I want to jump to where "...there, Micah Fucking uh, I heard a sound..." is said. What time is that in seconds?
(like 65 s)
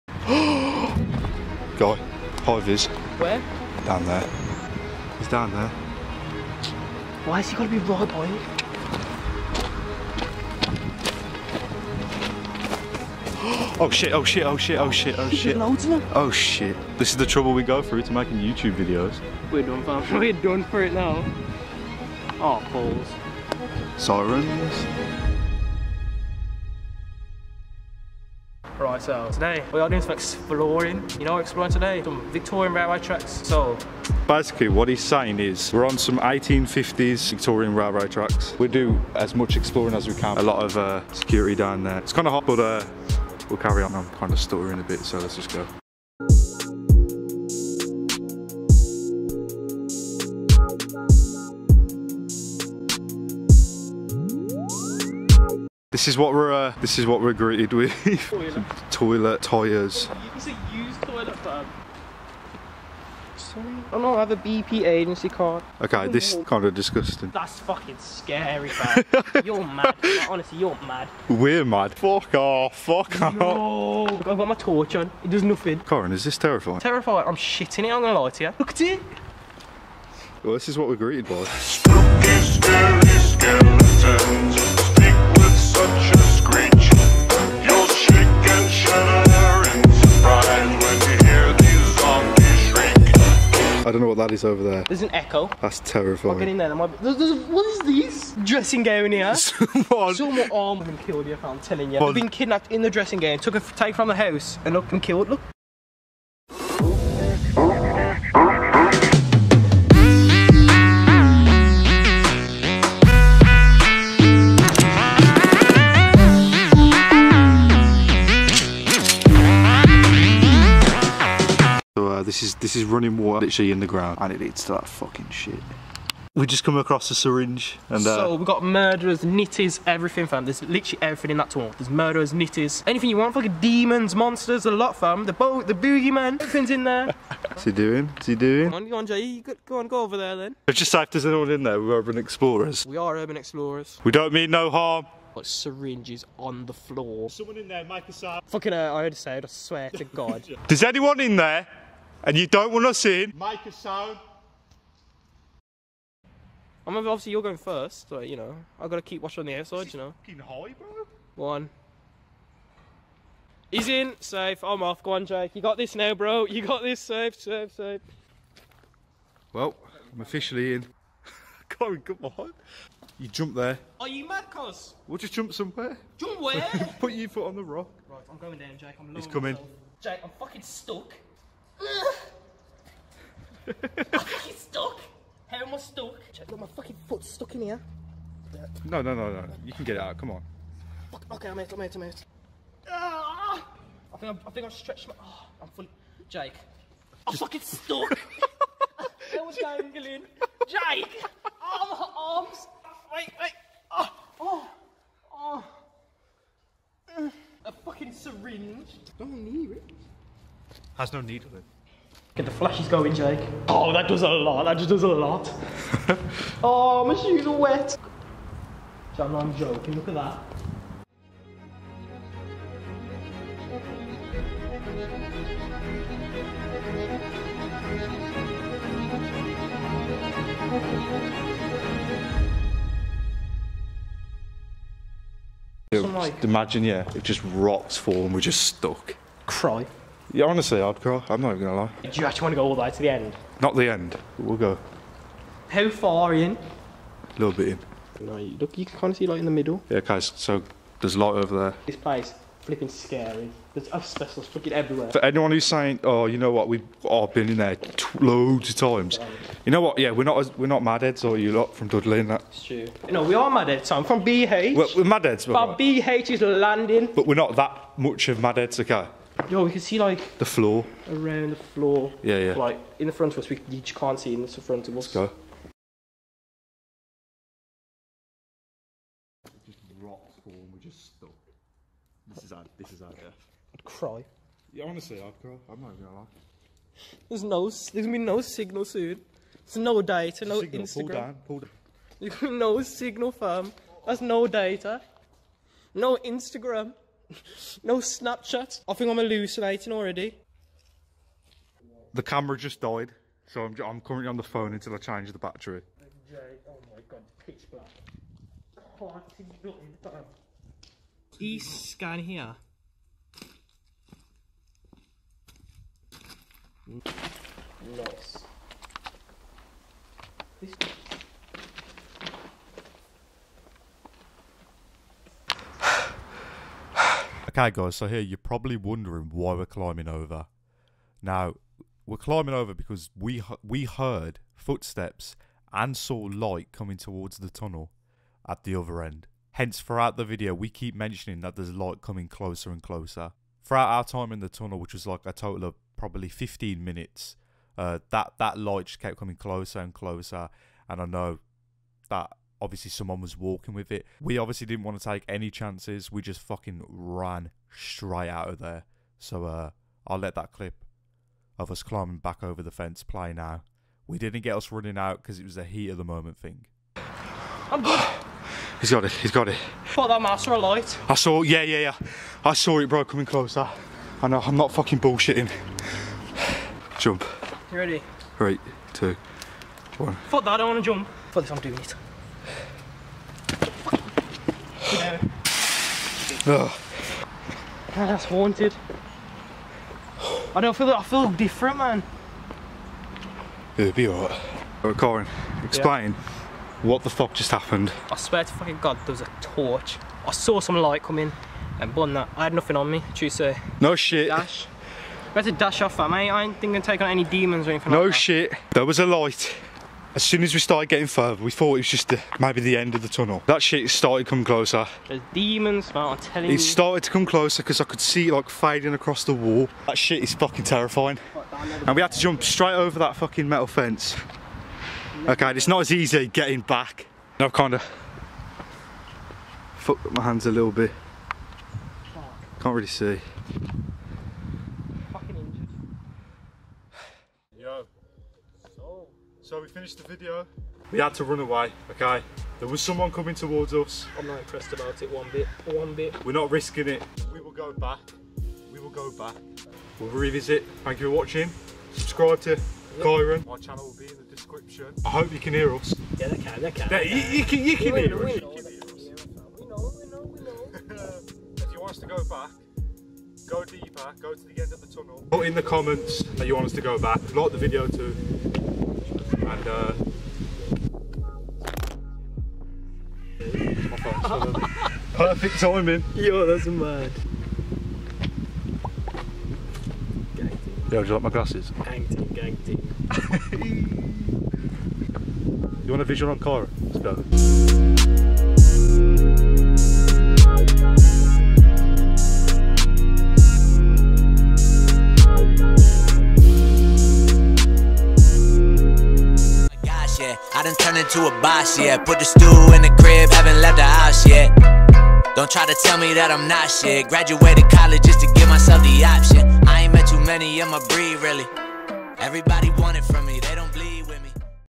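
147 s.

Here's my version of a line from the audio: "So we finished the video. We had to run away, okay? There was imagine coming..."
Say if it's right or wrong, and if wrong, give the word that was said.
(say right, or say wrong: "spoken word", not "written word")
wrong: "someone", not "imagine".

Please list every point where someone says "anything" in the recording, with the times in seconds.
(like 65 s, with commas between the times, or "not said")
132 s, 407 s.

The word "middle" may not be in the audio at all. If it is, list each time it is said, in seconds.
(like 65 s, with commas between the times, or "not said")
249 s.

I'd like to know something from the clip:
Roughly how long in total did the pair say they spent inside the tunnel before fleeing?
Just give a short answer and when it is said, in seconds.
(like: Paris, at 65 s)
15 minutes, at 346 s.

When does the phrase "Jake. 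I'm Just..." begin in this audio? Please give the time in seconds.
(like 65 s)
196 s.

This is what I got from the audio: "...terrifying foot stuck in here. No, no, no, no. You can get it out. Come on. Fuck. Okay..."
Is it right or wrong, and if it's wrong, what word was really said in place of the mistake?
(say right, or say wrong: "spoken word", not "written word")
wrong: "fucking", not "terrifying".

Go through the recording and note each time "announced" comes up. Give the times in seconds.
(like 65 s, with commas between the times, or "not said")
not said.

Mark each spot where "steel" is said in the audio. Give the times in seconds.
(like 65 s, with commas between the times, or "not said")
not said.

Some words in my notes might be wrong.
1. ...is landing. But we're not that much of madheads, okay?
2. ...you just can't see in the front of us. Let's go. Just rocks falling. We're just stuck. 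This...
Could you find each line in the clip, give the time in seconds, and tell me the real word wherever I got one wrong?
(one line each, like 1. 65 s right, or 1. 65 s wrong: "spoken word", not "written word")
1. 266 s right
2. 273 s right.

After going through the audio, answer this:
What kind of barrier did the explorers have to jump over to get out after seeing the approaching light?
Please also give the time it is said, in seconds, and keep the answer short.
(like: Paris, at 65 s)
Metal fence, at 423 s.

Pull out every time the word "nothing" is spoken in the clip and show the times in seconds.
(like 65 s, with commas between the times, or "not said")
75 s, 309 s, 402 s.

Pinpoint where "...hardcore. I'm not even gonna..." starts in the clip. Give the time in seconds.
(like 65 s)
240 s.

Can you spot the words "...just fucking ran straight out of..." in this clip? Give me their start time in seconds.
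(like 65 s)
356 s.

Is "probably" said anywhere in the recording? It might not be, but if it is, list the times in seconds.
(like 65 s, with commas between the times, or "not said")
328 s, 345 s.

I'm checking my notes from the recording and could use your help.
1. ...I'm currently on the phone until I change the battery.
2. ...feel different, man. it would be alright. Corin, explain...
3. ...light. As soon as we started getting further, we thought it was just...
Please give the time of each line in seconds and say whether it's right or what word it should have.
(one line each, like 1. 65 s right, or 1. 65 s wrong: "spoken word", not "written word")
1. 303 s right
2. 391 s right
3. 409 s right.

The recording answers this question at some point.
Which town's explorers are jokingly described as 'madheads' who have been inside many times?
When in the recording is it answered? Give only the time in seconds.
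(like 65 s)
261 s.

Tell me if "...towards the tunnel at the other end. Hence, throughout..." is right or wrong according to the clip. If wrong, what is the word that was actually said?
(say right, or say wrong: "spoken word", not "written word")
right.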